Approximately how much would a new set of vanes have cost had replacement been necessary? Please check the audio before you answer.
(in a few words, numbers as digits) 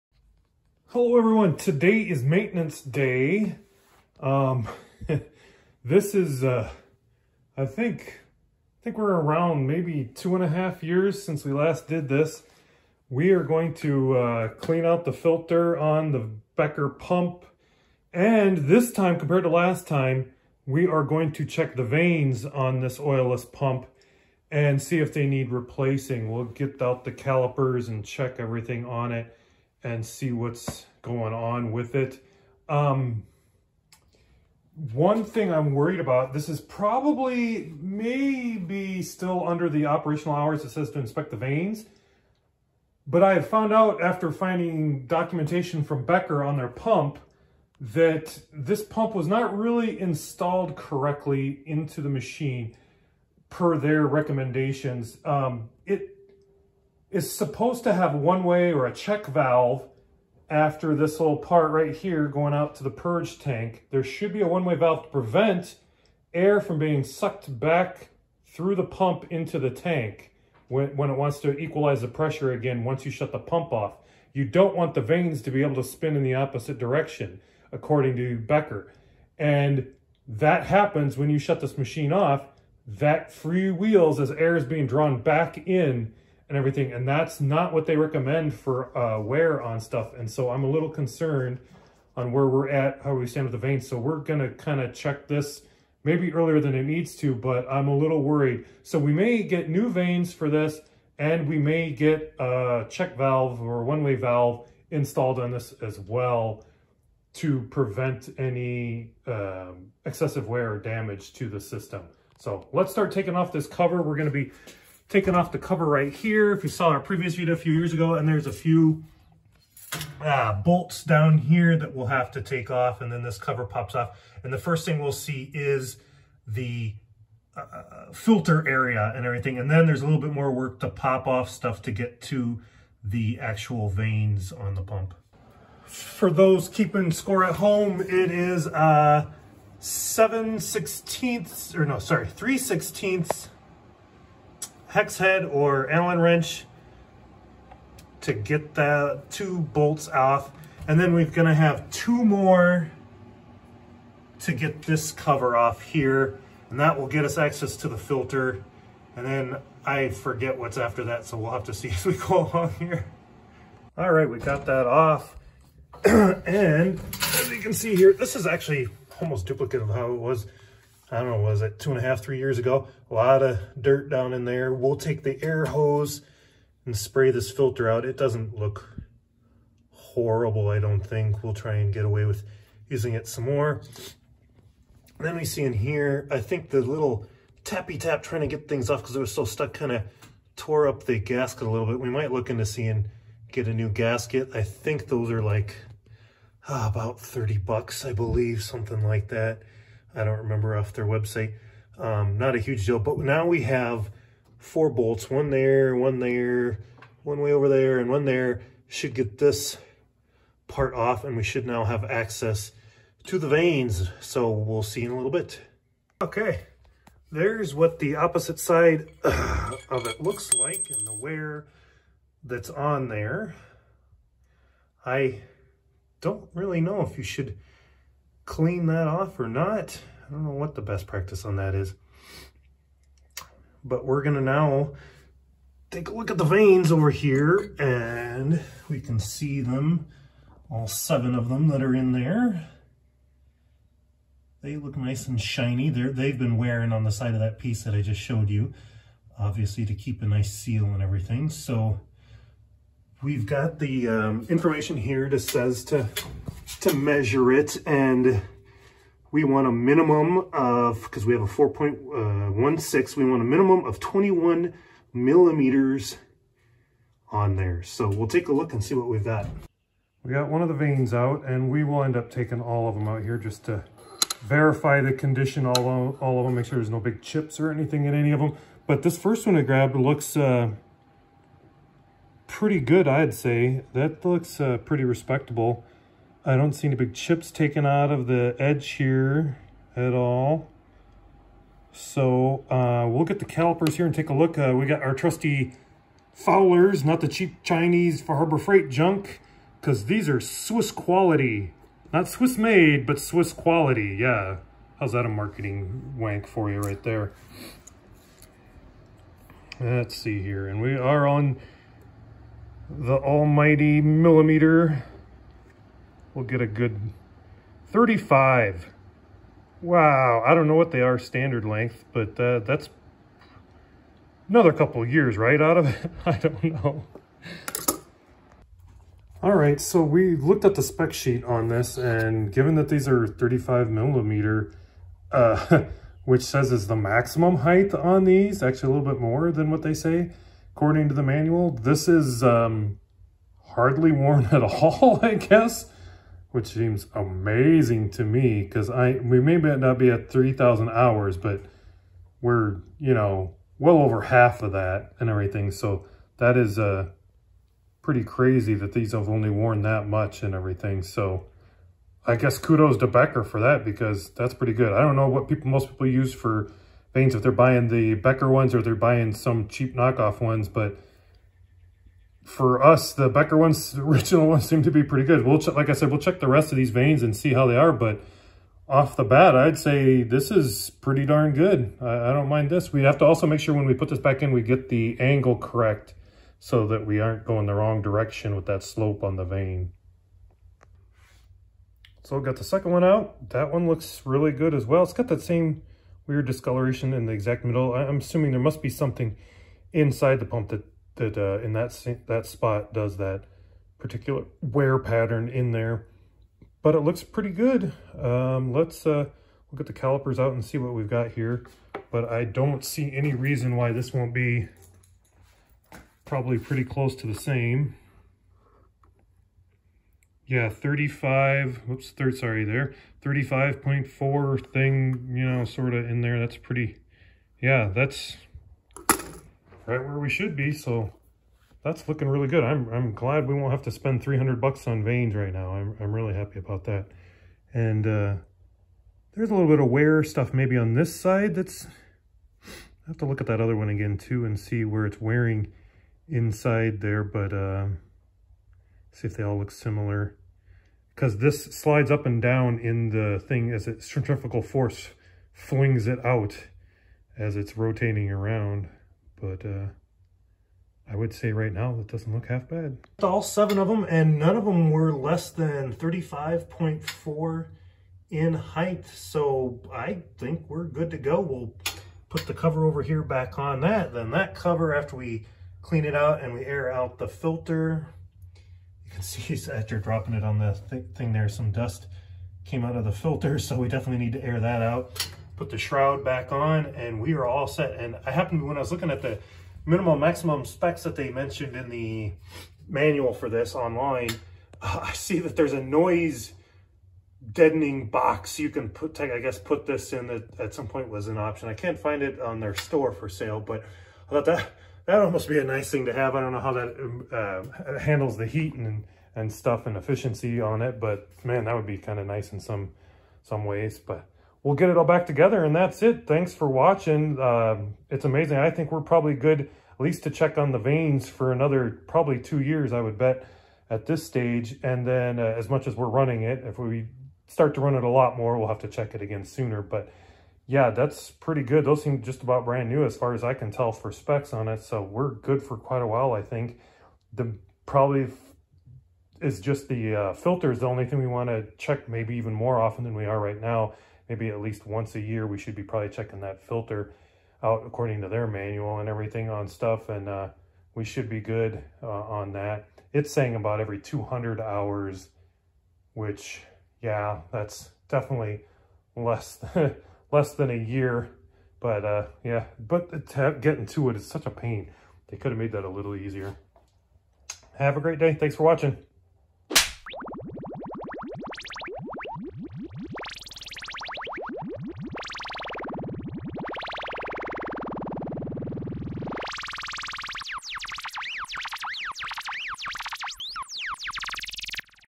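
$300.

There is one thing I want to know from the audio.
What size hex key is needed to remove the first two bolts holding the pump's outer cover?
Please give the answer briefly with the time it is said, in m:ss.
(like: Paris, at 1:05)
3/16, at 2:22.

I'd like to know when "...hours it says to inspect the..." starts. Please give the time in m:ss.
0:40.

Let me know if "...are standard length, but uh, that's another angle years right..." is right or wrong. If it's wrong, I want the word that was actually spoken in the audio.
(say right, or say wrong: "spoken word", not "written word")
wrong: "couple", not "angle".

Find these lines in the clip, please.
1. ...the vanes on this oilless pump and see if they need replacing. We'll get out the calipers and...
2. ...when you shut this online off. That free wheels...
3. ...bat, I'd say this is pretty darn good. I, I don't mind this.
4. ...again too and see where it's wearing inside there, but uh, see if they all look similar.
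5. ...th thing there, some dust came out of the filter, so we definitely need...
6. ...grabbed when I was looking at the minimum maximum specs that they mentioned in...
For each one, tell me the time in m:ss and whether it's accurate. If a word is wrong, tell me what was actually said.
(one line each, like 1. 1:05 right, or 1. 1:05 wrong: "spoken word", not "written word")
1. 0:21 right
2. 1:21 wrong: "machine", not "online"
3. 6:19 right
4. 7:23 right
5. 8:00 right
6. 8:08 wrong: "happened", not "grabbed".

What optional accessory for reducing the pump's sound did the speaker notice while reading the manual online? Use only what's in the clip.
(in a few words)
noise deadening box.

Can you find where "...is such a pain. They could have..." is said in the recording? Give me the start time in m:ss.
9:24.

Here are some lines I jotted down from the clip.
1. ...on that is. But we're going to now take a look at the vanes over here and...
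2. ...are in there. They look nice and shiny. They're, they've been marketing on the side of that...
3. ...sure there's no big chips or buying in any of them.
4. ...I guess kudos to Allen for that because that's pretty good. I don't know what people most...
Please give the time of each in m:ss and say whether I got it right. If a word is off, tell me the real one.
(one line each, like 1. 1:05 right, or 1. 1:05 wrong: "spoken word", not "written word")
1. 3:51 right
2. 4:01 wrong: "wearing", not "marketing"
3. 4:36 wrong: "anything", not "buying"
4. 6:02 wrong: "Becker", not "Allen".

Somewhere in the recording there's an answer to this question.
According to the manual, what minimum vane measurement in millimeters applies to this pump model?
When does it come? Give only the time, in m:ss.
4:23.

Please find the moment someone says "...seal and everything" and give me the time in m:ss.
4:10.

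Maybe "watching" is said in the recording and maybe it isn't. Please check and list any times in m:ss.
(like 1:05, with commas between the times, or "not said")
8:36, 9:28.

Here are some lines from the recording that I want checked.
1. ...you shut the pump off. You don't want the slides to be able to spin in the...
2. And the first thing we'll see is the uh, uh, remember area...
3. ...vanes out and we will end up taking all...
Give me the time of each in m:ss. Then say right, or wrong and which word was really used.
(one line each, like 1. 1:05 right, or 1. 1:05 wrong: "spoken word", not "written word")
1. 1:13 wrong: "vanes", not "slides"
2. 2:04 wrong: "filter", not "remember"
3. 4:30 right.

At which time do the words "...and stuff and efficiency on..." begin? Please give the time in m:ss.
8:29.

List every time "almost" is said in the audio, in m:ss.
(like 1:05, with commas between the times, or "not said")
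2:49, 8:25.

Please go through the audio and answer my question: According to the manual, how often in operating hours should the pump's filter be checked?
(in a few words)
every 200 hours.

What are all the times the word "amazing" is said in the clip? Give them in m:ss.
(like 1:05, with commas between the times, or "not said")
5:47, 8:38.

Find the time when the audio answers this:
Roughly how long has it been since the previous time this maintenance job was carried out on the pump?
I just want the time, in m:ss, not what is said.
0:10.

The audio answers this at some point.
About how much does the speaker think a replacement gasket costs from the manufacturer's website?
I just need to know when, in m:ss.
3:17.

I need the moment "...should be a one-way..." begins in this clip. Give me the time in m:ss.
1:04.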